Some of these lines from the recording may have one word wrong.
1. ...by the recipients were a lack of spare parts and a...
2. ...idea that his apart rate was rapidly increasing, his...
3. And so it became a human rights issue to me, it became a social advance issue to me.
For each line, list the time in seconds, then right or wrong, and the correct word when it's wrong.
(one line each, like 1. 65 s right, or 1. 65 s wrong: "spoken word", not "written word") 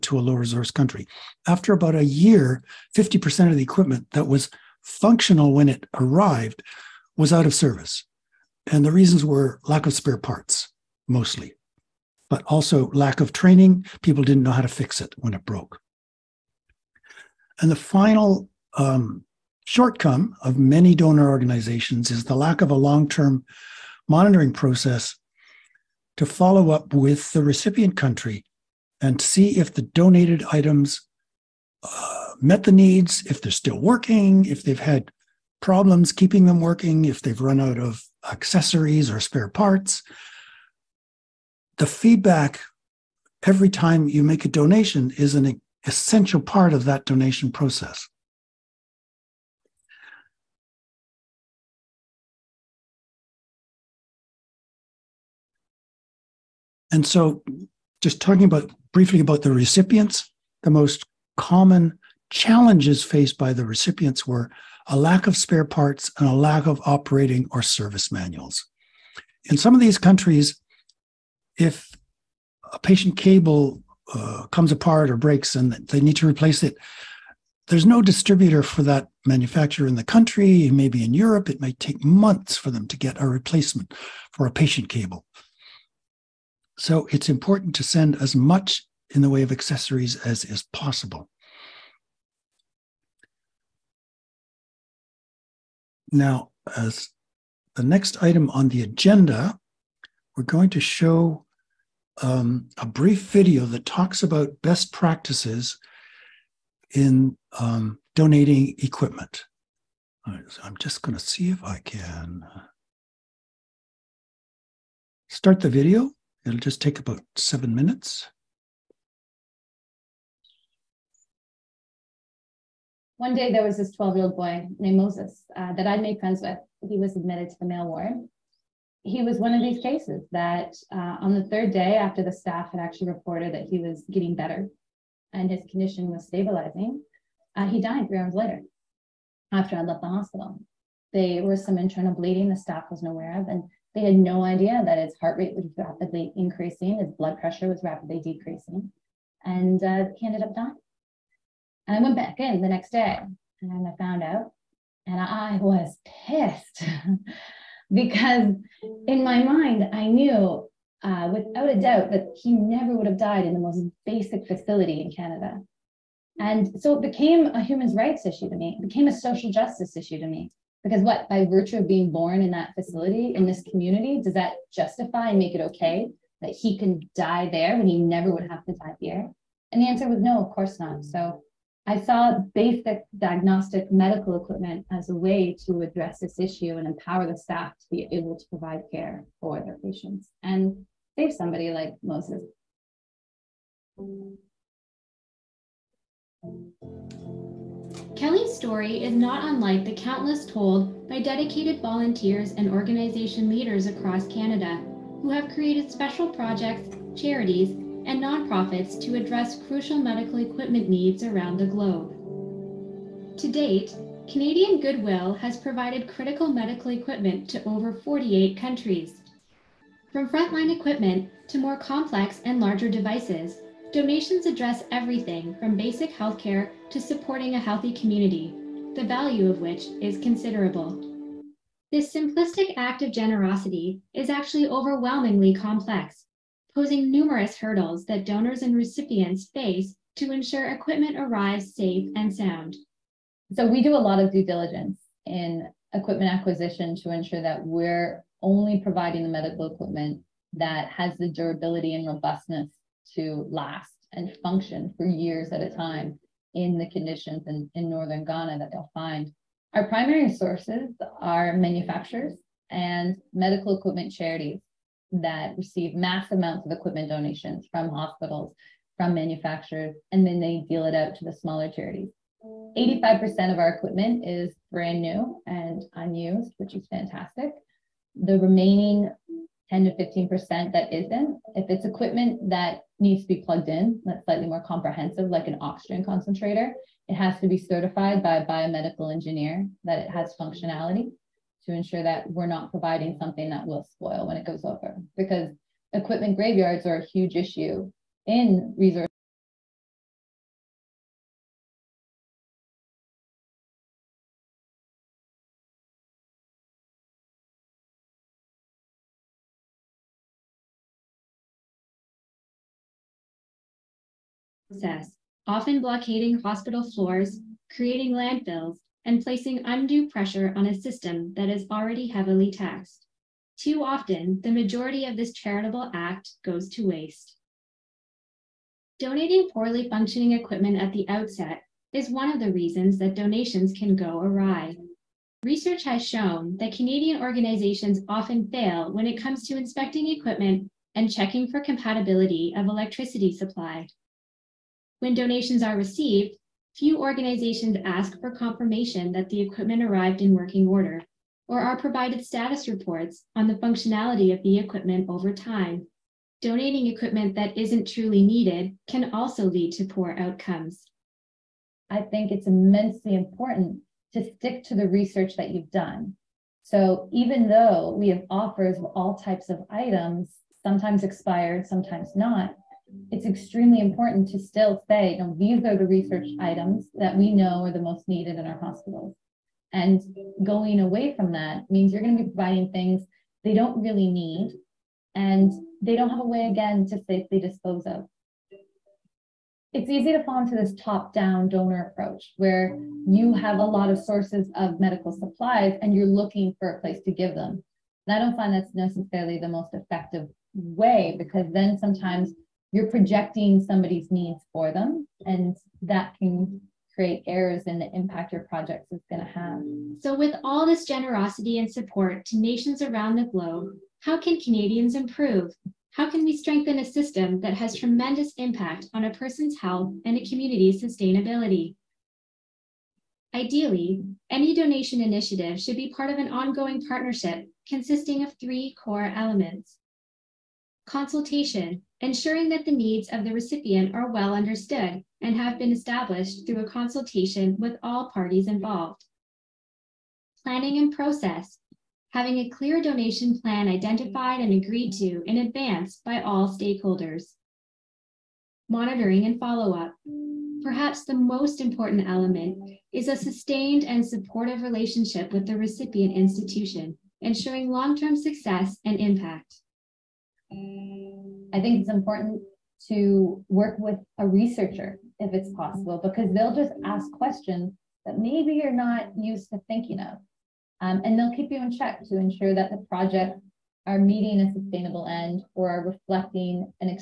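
1. 63 s right
2. 144 s wrong: "heart", not "apart"
3. 166 s wrong: "justice", not "advance".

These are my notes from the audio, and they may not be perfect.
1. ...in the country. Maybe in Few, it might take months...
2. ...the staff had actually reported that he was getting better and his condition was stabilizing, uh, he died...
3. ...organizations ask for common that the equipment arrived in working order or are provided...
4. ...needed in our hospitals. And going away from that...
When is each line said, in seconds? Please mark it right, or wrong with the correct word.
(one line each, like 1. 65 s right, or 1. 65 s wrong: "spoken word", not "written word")
1. 79 s wrong: "Europe", not "Few"
2. 132 s right
3. 346 s wrong: "confirmation", not "common"
4. 378 s right.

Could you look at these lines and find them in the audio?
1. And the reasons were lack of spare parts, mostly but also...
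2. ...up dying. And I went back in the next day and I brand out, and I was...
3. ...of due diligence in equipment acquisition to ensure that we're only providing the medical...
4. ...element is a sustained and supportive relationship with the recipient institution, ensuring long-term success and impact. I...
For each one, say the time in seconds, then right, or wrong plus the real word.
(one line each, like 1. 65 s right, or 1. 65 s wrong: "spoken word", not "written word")
1. 8 s right
2. 150 s wrong: "found", not "brand"
3. 244 s right
4. 452 s right.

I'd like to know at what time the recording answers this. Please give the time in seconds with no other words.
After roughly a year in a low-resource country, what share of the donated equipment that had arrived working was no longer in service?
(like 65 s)
2 s.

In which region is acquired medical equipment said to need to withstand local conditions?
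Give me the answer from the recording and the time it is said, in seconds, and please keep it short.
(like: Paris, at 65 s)
Northern Ghana, at 257 s.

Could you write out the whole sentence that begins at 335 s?
Research has shown that Canadian organizations often fail when it comes to inspecting equipment and checking for compatibility of electricity supply.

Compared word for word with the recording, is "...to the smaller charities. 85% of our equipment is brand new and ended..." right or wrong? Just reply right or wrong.
wrong.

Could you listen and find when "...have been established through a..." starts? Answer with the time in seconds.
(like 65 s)
435 s.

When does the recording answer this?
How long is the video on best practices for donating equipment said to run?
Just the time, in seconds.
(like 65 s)
116 s.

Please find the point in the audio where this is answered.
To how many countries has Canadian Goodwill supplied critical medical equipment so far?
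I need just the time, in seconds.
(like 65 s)
217 s.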